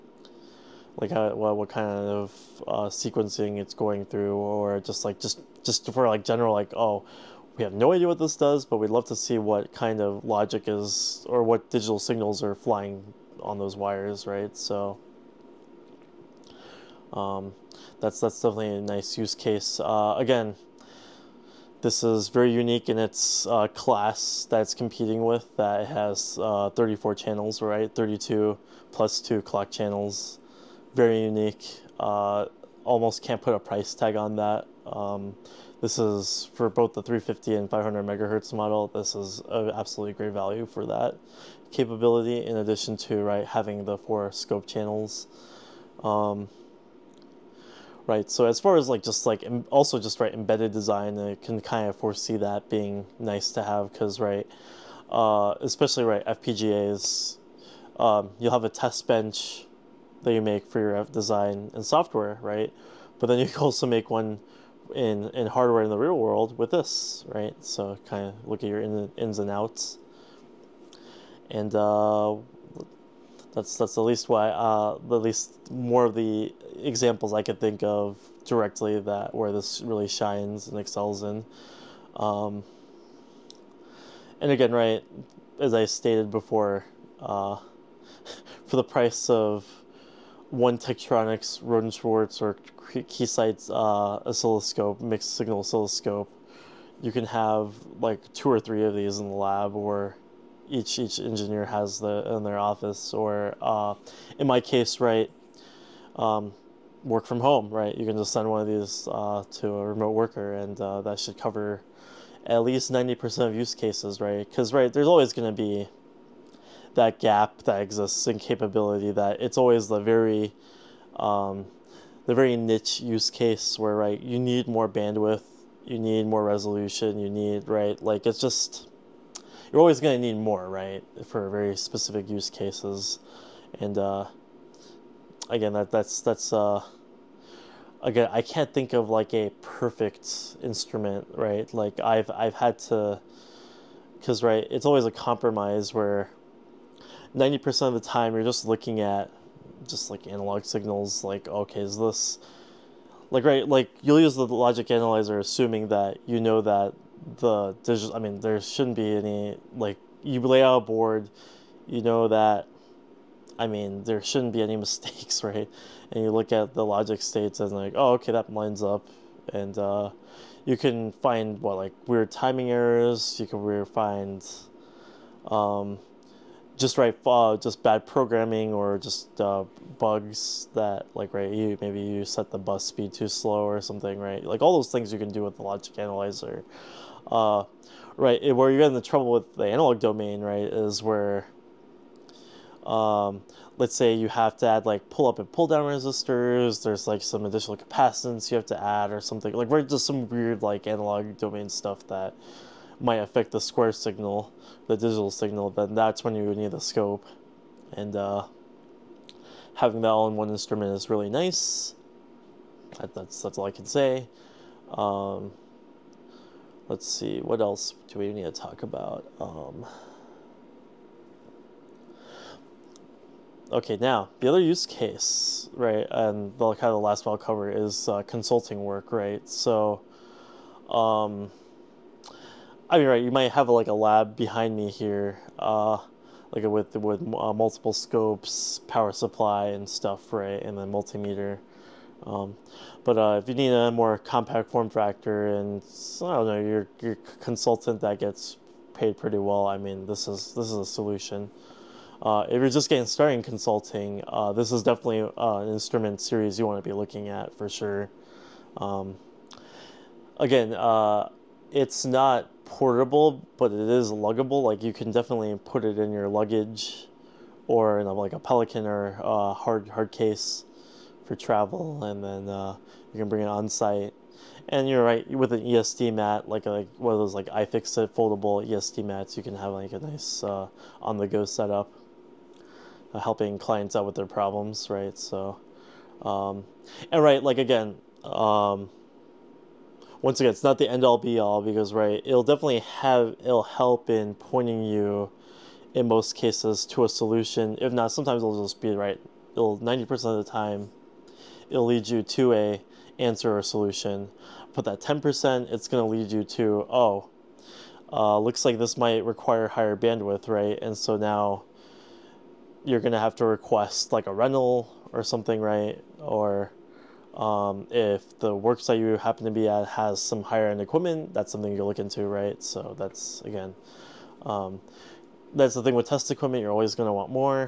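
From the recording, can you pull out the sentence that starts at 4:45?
So, um, and right, like again.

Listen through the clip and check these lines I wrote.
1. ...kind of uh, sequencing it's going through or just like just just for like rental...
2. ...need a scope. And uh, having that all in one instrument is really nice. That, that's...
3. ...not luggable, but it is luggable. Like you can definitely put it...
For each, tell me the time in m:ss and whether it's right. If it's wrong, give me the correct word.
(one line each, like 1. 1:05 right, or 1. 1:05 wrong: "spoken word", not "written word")
1. 0:01 wrong: "general", not "rental"
2. 3:26 right
3. 4:22 wrong: "portable", not "luggable".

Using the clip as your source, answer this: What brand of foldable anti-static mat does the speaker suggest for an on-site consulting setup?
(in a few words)
iFixit.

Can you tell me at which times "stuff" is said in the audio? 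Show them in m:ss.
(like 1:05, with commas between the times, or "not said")
3:21, 3:59.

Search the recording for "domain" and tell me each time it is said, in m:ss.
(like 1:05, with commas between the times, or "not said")
3:09, 3:21.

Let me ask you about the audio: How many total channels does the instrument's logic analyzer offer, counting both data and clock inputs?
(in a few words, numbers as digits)
34.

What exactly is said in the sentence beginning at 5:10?
And so now you're gonna have to request like a rental or something, right?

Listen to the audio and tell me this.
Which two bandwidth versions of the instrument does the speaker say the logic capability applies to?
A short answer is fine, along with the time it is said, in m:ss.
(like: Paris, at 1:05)
350 and 500 MHz, at 0:37.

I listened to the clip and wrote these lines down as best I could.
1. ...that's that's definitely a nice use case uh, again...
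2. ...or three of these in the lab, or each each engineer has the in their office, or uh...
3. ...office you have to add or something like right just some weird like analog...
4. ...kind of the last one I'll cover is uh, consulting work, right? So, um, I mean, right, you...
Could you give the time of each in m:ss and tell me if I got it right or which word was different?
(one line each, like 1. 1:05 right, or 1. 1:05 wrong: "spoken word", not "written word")
1. 0:18 right
2. 1:38 right
3. 3:17 wrong: "capacitance", not "office"
4. 3:46 right.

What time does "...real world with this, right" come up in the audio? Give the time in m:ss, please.
1:05.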